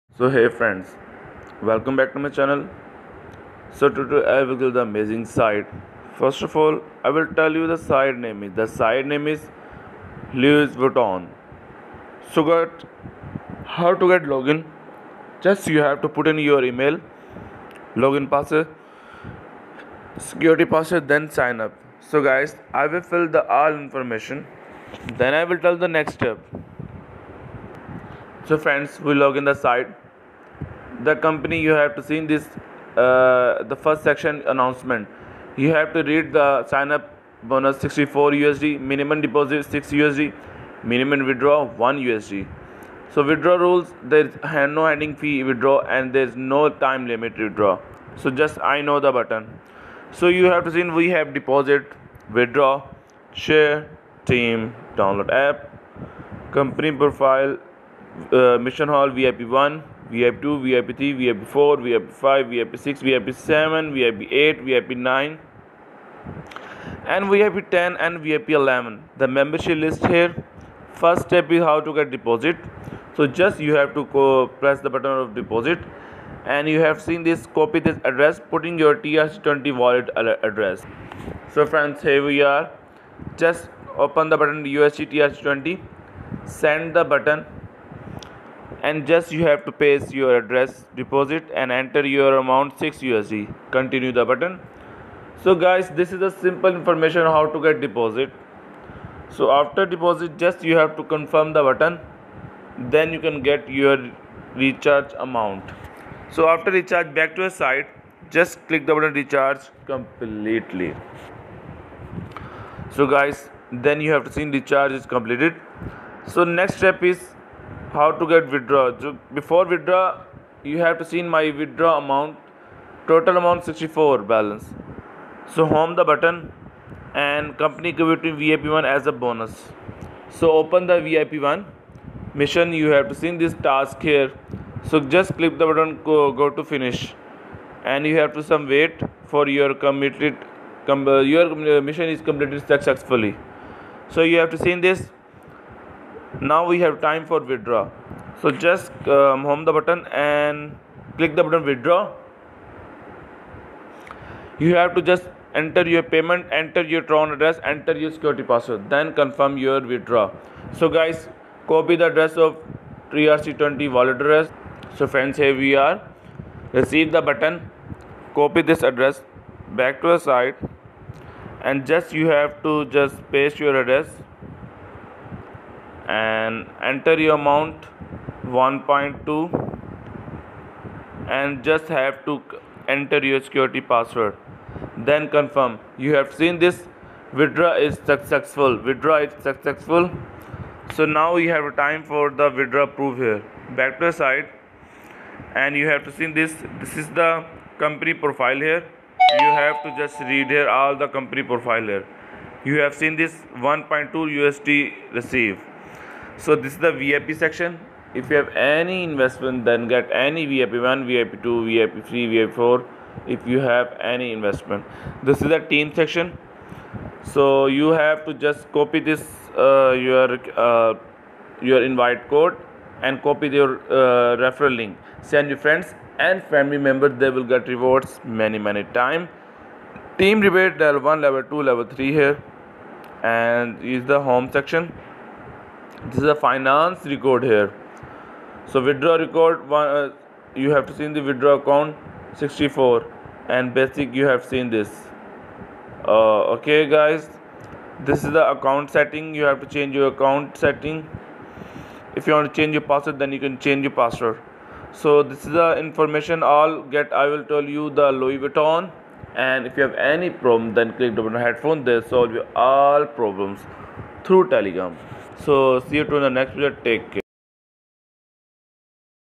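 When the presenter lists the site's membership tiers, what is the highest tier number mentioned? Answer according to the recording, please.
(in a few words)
VIP 11.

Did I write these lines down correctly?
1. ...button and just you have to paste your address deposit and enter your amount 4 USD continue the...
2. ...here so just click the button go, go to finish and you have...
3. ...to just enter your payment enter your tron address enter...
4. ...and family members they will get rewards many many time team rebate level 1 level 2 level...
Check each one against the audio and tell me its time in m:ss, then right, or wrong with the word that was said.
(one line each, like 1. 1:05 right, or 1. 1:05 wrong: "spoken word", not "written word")
1. 1:27 wrong: "6", not "4"
2. 2:14 right
3. 2:34 right
4. 3:46 right.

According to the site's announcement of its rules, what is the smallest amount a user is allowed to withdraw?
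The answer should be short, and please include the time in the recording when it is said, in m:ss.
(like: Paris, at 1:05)
1 USD, at 0:41.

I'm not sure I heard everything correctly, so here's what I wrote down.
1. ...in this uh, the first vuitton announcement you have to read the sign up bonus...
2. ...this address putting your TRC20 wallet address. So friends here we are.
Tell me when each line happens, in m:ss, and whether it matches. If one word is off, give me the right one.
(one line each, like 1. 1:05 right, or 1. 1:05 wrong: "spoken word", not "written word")
1. 0:32 wrong: "section", not "vuitton"
2. 1:17 right.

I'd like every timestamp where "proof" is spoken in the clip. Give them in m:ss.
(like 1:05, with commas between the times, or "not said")
3:12.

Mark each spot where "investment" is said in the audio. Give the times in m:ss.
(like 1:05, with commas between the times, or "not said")
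3:29, 3:34.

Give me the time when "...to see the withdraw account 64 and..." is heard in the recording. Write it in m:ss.
4:00.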